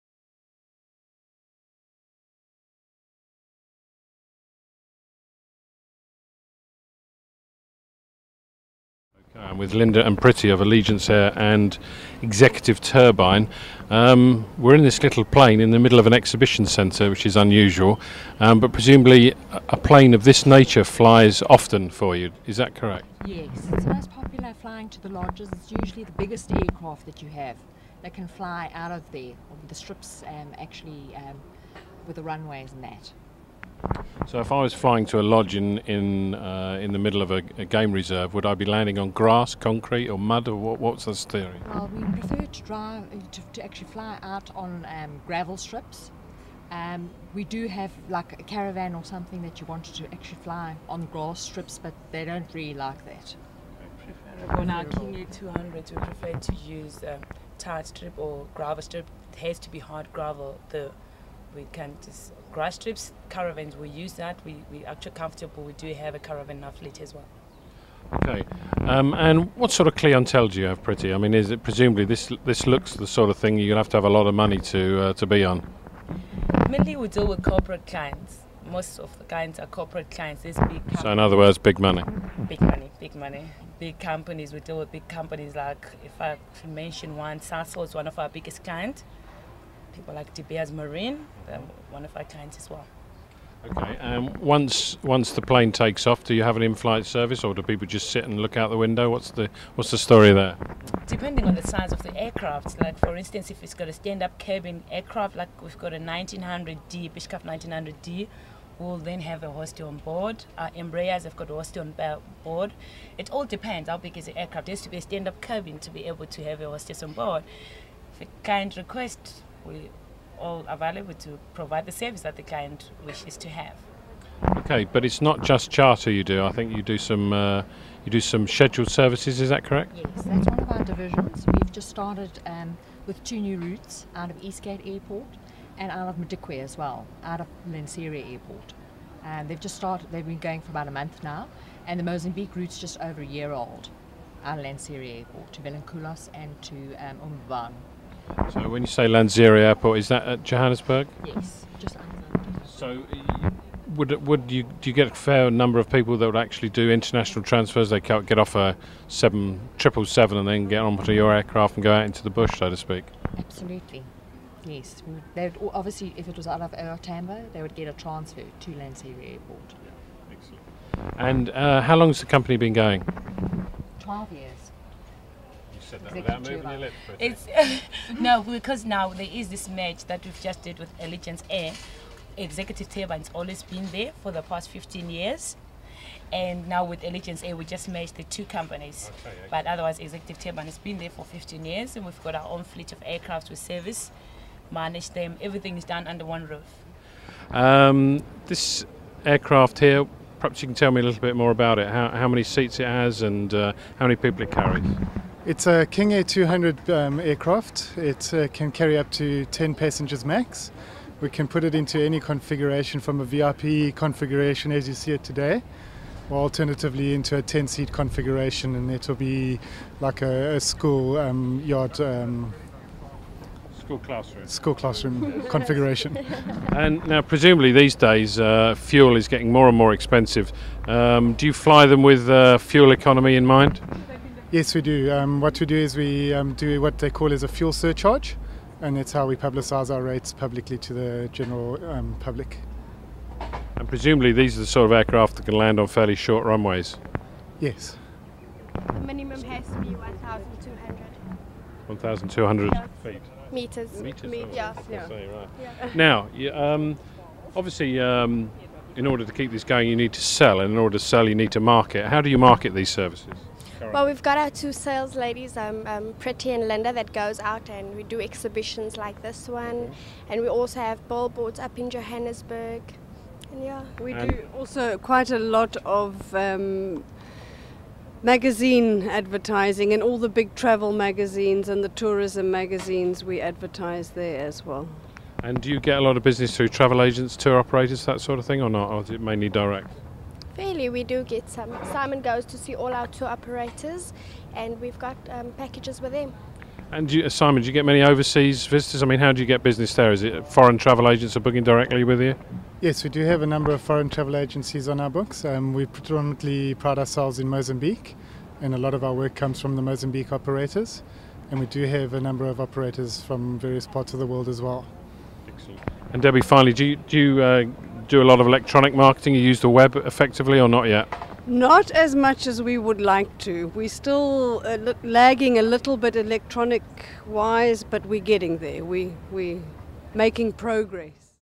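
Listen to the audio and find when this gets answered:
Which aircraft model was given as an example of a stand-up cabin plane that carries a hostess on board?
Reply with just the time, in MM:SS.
01:47.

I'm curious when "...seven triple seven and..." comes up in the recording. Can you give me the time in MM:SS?
02:39.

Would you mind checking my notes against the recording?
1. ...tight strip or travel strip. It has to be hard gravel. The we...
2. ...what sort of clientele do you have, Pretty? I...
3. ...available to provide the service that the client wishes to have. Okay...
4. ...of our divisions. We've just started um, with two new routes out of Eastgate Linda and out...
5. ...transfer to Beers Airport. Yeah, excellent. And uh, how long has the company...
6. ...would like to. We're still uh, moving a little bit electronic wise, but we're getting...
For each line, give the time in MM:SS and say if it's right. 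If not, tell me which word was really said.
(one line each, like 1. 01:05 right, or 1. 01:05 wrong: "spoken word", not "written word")
1. 00:57 wrong: "gravel", not "travel"
2. 01:09 right
3. 02:00 right
4. 02:10 wrong: "Airport", not "Linda"
5. 02:47 wrong: "Lanseria", not "Beers"
6. 05:22 wrong: "lagging", not "moving".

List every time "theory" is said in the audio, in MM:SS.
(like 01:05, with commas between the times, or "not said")
00:41.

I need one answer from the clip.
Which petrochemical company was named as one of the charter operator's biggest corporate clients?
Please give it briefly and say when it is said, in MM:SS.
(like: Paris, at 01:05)
Sasol, at 01:27.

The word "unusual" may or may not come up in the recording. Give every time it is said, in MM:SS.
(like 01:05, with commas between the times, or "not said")
00:17.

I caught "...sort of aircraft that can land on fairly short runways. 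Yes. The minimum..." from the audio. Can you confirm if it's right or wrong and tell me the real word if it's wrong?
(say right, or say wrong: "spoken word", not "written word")
right.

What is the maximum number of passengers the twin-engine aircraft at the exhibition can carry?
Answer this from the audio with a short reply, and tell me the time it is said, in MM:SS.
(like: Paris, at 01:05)
10, at 03:29.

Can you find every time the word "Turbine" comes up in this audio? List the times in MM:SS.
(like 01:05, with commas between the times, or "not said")
00:12, 03:02, 03:10.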